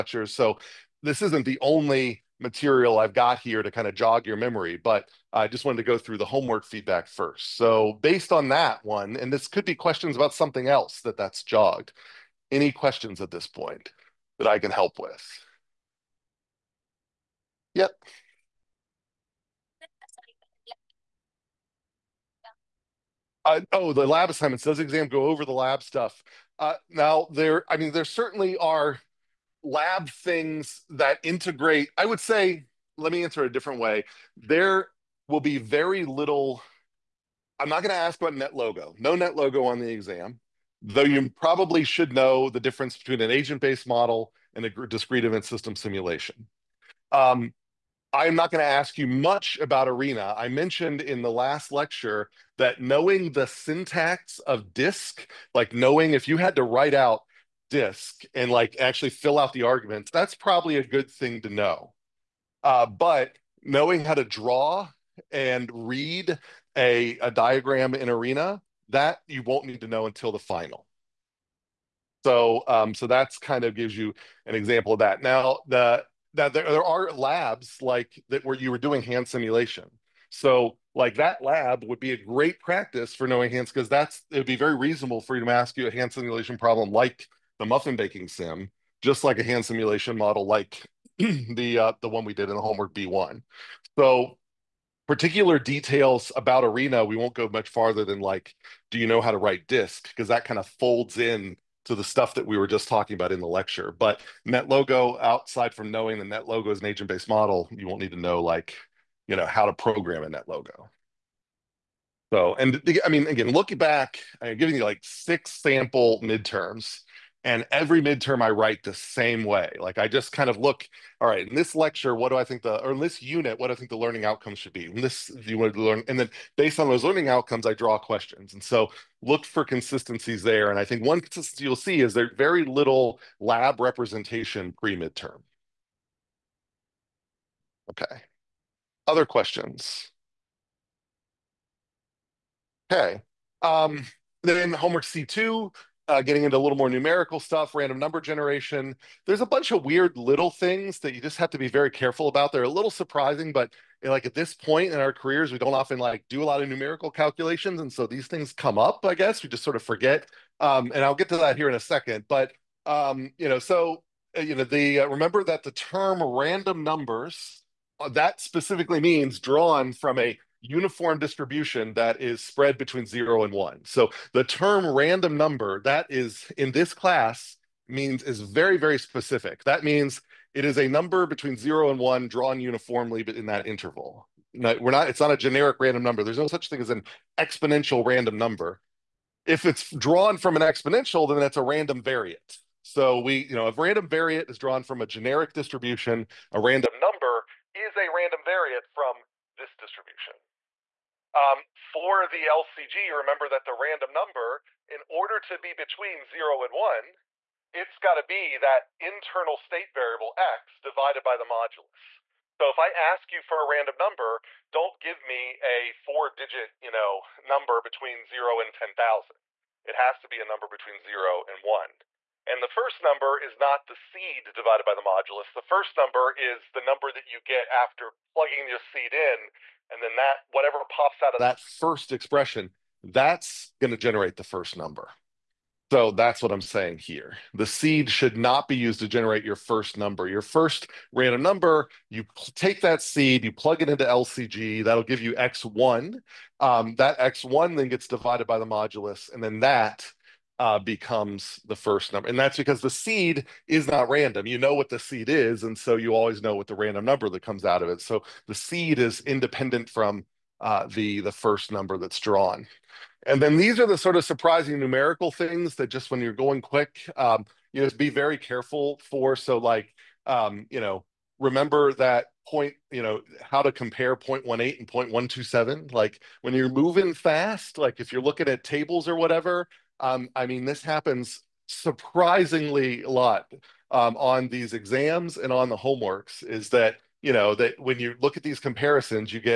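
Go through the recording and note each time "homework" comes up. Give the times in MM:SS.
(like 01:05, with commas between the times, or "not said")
00:06, 01:32, 02:24, 04:45.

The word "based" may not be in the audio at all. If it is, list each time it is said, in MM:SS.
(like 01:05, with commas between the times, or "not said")
00:08, 00:43, 01:47, 02:06.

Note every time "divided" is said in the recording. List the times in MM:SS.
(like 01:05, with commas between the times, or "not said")
03:30, 03:44, 04:08.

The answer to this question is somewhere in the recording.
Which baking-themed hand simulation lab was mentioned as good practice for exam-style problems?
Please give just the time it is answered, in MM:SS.
01:27.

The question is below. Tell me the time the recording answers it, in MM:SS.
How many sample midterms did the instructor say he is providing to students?
01:55.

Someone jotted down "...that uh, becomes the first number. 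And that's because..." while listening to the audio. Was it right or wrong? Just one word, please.
right.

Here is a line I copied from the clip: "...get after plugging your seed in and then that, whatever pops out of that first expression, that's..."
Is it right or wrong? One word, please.
right.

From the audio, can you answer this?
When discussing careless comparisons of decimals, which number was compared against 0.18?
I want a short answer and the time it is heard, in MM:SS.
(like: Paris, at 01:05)
0.127, at 04:34.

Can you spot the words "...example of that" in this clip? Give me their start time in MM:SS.
01:14.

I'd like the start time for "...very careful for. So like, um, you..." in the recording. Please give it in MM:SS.
04:28.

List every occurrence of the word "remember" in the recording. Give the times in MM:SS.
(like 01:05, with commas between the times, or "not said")
02:45, 03:23, 04:31.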